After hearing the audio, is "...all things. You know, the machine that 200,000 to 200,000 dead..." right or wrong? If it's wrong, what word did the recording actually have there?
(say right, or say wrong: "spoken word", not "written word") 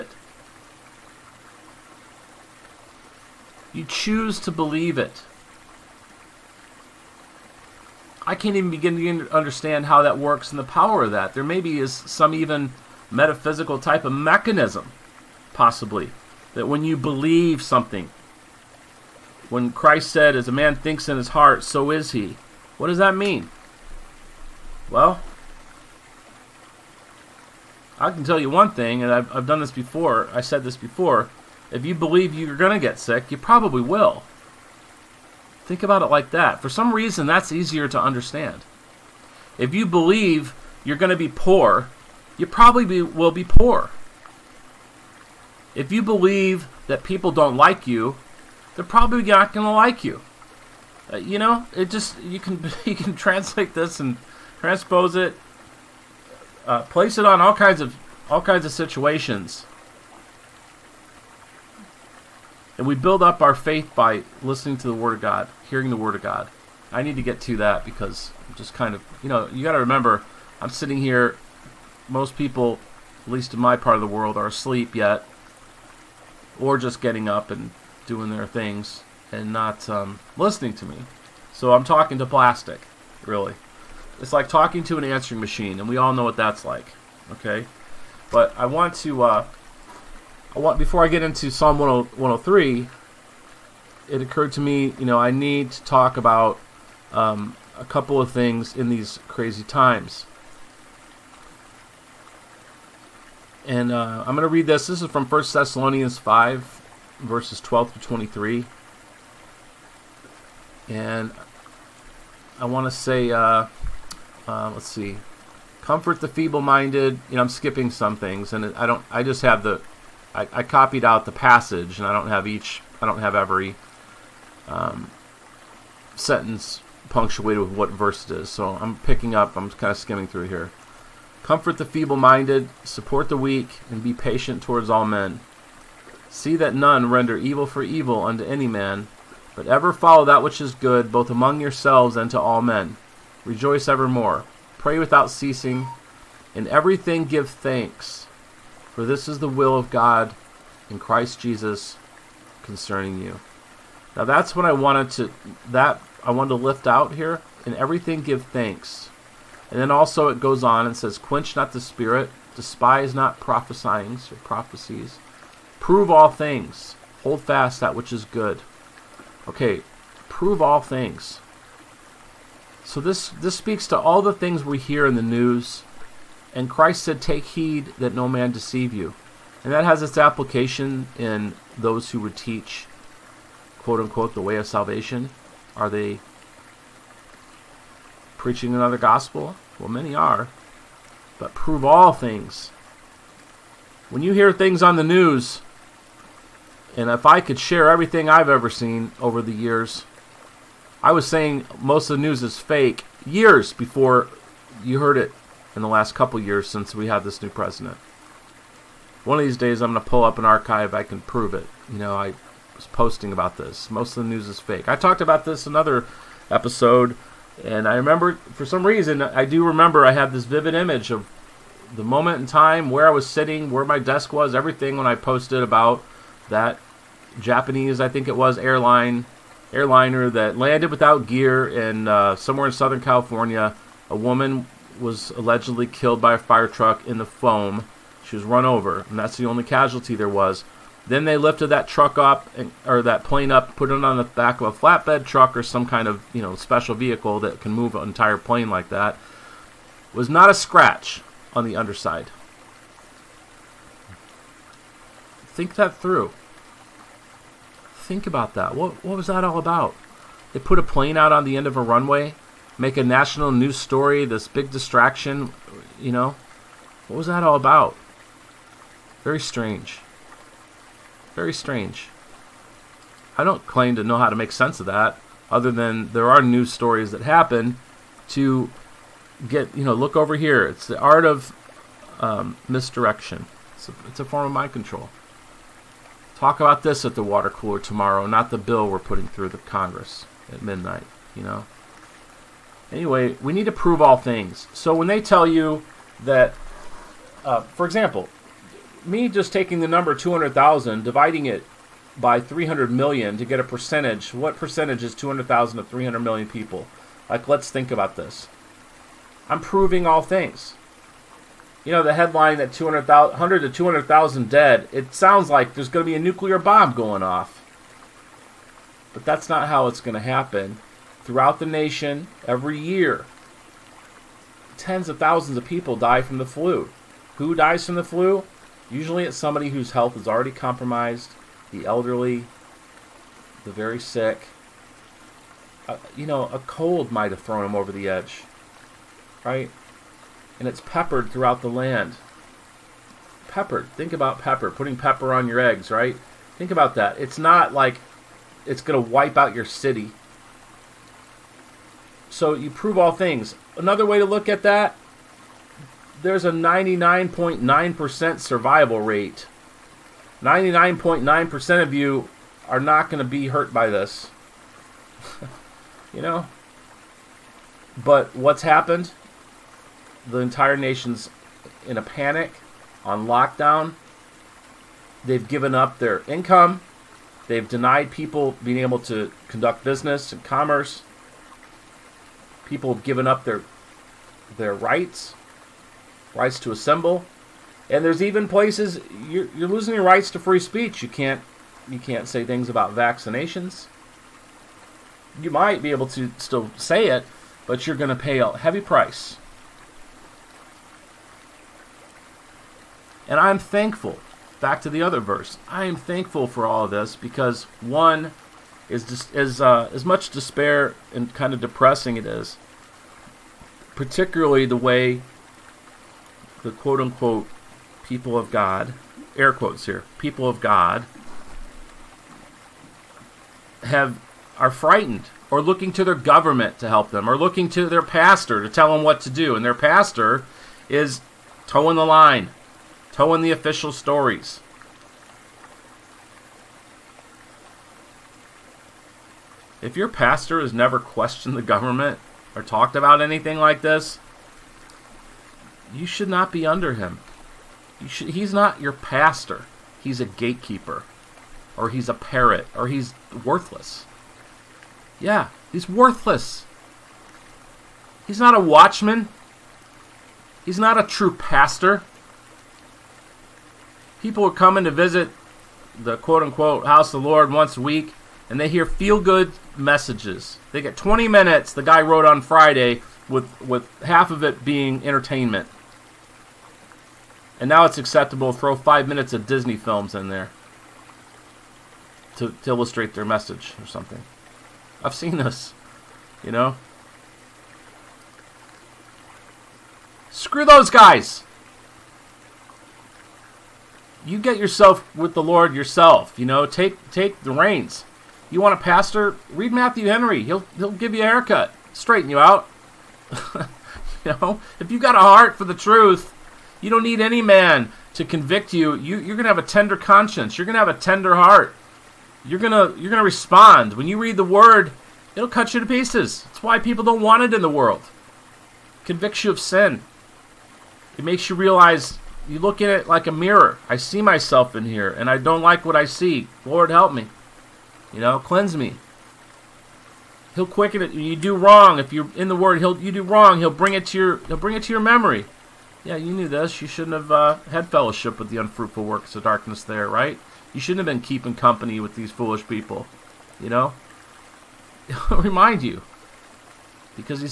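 wrong: "headline", not "machine".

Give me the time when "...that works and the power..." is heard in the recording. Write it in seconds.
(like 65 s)
10 s.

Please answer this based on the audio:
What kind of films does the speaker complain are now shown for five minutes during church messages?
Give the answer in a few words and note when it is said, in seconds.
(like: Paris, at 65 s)
Disney films, at 479 s.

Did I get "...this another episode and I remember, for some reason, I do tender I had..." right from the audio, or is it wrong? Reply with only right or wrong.
wrong.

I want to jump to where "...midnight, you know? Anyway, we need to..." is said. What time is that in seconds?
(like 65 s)
290 s.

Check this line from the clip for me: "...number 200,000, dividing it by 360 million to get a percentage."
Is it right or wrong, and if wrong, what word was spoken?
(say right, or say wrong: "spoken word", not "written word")
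wrong: "300", not "360".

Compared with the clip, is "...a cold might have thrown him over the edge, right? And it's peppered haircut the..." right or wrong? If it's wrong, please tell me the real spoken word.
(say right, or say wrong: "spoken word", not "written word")
wrong: "throughout", not "haircut".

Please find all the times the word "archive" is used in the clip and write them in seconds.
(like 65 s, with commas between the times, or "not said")
210 s.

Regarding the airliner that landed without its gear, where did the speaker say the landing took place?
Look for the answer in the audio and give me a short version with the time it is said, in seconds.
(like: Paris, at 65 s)
Southern California, at 232 s.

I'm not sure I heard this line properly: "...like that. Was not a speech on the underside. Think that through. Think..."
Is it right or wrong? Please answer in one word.
wrong.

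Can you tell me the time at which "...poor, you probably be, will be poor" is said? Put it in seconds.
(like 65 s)
41 s.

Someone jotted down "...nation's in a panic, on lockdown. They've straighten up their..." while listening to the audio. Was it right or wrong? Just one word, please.
wrong.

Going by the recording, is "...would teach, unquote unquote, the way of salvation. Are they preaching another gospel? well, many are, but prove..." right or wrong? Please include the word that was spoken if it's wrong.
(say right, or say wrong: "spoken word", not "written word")
wrong: "quote", not "unquote".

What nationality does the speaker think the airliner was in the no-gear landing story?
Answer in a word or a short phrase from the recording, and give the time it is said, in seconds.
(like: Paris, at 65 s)
Japanese, at 227 s.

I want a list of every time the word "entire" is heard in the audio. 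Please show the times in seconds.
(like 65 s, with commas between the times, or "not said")
248 s, 370 s.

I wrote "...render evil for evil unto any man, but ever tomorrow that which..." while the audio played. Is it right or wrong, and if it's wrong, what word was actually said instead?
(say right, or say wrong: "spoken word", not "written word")
wrong: "follow", not "tomorrow".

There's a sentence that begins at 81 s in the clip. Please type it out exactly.
So I'm talking to plastic, really.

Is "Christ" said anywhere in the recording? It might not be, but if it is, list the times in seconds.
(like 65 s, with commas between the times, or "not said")
19 s, 150 s, 176 s.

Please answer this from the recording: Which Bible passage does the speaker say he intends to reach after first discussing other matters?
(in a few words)
Psalm 103.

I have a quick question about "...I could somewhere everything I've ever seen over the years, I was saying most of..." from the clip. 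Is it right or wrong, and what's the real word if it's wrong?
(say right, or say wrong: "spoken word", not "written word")
wrong: "share", not "somewhere".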